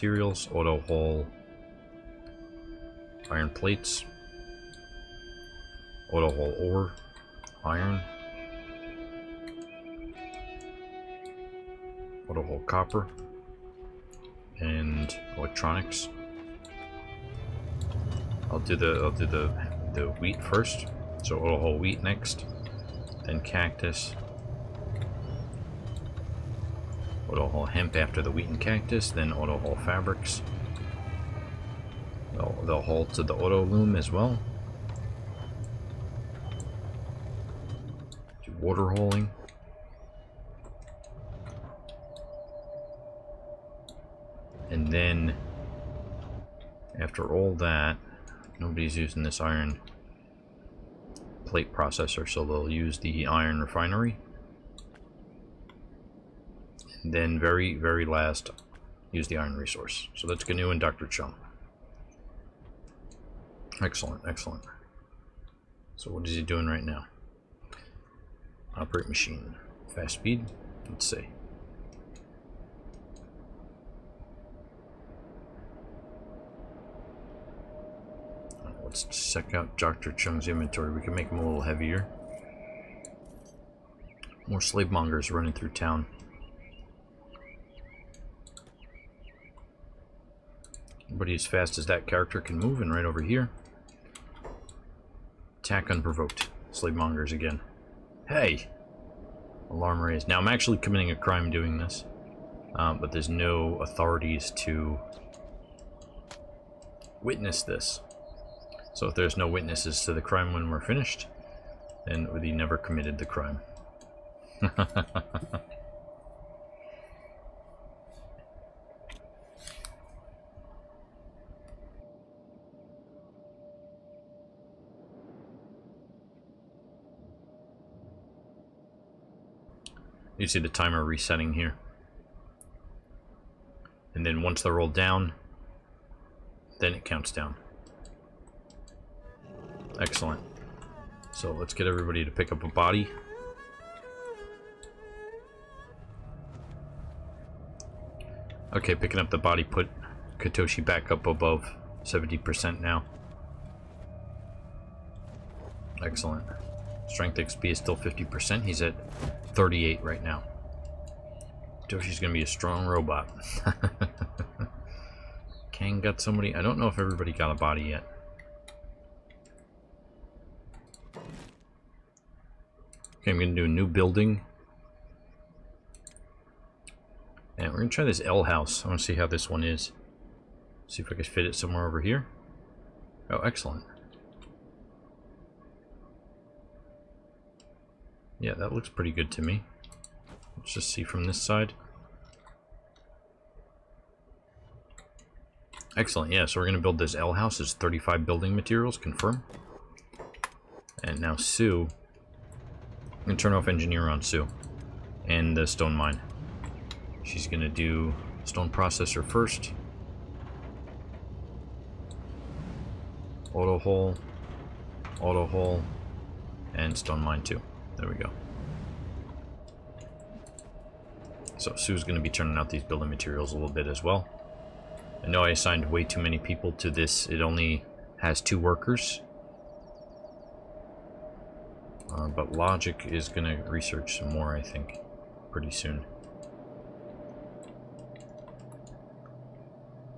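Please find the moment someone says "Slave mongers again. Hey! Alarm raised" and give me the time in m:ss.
1:36.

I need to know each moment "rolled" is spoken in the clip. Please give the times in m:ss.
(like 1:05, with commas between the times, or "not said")
2:14.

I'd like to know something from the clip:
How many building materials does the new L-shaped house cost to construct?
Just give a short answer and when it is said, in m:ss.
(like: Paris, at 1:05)
35, at 3:17.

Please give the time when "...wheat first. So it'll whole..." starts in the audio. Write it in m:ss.
0:20.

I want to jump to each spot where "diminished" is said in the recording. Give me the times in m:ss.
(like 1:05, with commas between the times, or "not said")
not said.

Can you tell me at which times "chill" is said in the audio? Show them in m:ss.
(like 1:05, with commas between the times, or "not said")
not said.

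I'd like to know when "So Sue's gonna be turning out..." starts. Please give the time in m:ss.
3:41.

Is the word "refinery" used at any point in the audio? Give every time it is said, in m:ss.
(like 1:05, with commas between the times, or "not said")
0:53.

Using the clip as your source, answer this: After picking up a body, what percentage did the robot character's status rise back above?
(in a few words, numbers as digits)
70%.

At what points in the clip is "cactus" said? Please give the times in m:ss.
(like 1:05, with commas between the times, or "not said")
0:23, 0:28.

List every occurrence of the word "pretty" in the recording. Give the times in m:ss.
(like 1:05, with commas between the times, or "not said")
3:08, 3:55.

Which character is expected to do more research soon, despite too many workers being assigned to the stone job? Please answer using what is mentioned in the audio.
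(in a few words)
Logic.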